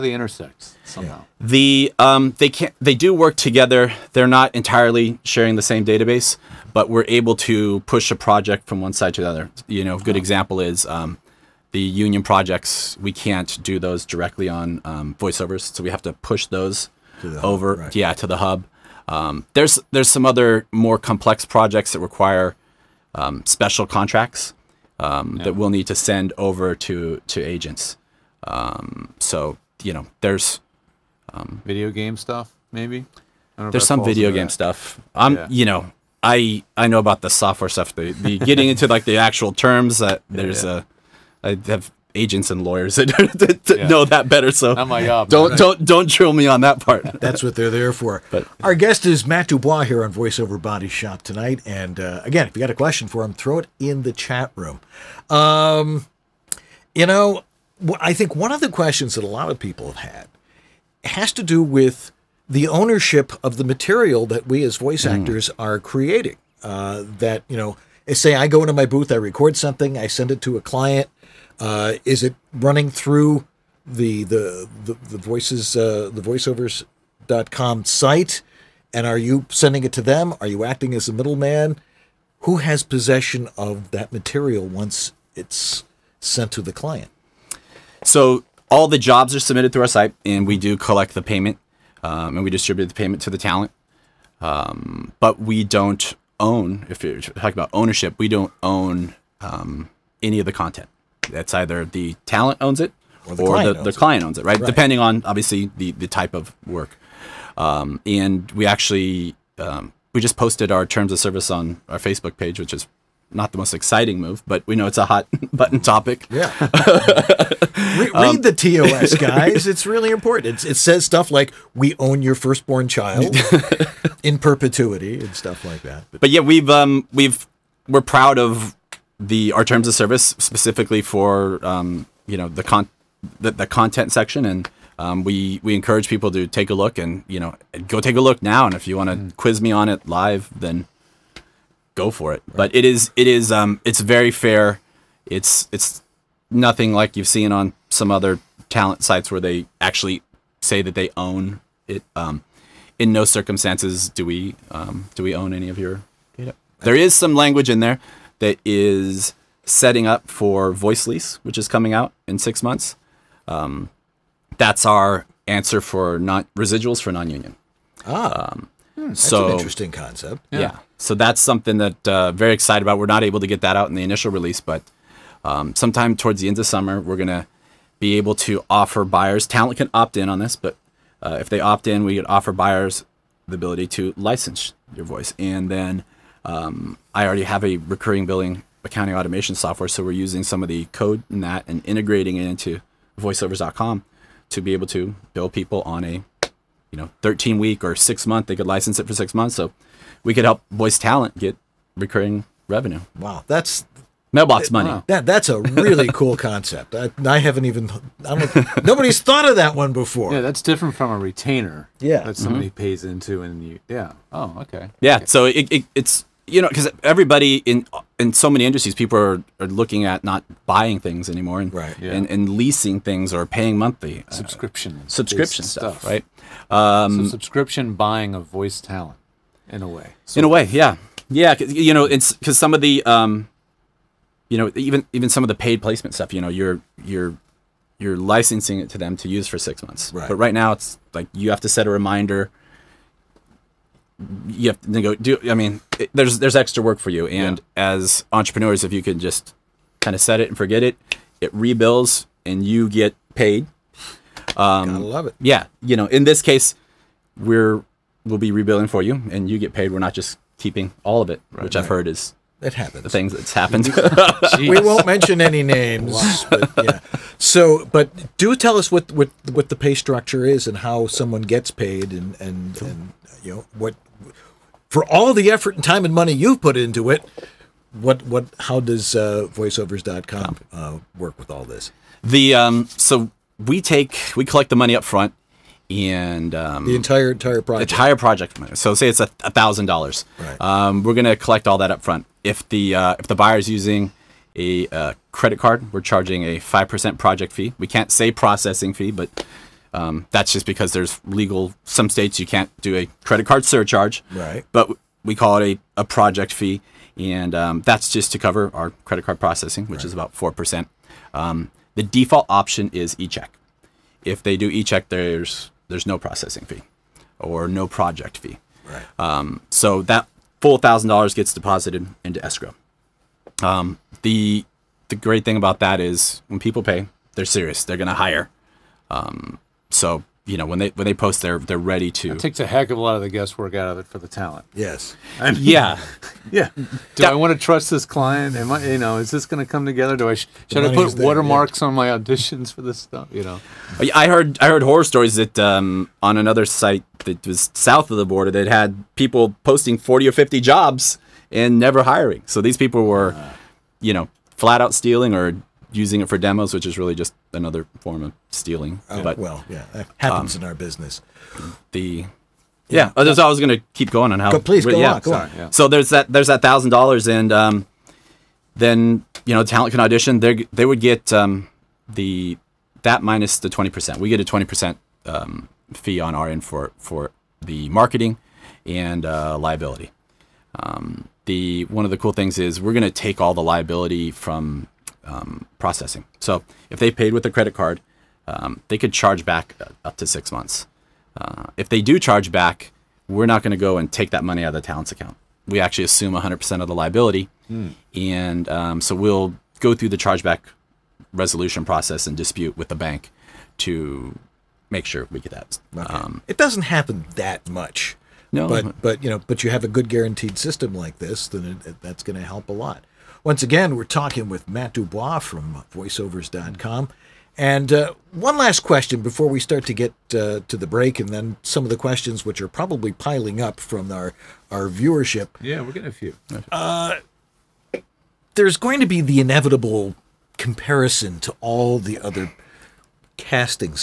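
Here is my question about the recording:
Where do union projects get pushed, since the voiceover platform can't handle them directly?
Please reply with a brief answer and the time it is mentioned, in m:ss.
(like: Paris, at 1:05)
the hub, at 0:18.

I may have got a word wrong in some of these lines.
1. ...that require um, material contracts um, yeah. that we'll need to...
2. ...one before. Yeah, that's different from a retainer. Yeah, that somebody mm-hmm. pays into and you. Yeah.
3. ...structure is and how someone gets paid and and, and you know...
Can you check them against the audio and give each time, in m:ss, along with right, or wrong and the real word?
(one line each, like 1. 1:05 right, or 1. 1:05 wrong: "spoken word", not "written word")
1. 0:21 wrong: "special", not "material"
2. 3:29 right
3. 4:29 right.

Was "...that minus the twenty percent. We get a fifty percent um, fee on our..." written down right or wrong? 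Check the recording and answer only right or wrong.
wrong.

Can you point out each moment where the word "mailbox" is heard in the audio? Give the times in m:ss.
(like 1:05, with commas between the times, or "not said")
3:24.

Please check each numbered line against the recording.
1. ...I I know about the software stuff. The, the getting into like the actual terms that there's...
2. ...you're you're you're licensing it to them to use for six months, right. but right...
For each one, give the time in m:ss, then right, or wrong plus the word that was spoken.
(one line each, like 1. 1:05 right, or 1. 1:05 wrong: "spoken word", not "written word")
1. 0:36 right
2. 3:56 right.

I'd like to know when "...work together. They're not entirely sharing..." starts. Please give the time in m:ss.
0:03.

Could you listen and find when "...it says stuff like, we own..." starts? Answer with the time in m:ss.
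2:00.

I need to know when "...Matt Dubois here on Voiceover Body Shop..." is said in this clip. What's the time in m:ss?
0:49.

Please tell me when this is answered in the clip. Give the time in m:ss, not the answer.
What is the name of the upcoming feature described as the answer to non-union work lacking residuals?
2:40.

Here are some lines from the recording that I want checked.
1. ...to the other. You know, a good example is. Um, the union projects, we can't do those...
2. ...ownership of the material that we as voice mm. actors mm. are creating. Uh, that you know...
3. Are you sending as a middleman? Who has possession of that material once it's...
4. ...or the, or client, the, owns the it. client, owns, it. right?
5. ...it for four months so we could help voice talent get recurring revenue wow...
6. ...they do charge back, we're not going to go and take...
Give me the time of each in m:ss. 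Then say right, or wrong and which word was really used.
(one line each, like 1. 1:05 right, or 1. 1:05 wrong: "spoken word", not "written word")
1. 0:09 right
2. 1:02 right
3. 1:20 wrong: "acting", not "sending"
4. 1:43 right
5. 3:18 wrong: "six", not "four"
6. 6:31 right.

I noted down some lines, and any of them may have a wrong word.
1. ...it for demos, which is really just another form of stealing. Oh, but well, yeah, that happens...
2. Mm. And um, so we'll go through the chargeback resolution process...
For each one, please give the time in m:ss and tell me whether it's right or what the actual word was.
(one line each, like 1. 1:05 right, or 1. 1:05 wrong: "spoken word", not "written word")
1. 5:56 right
2. 6:37 right.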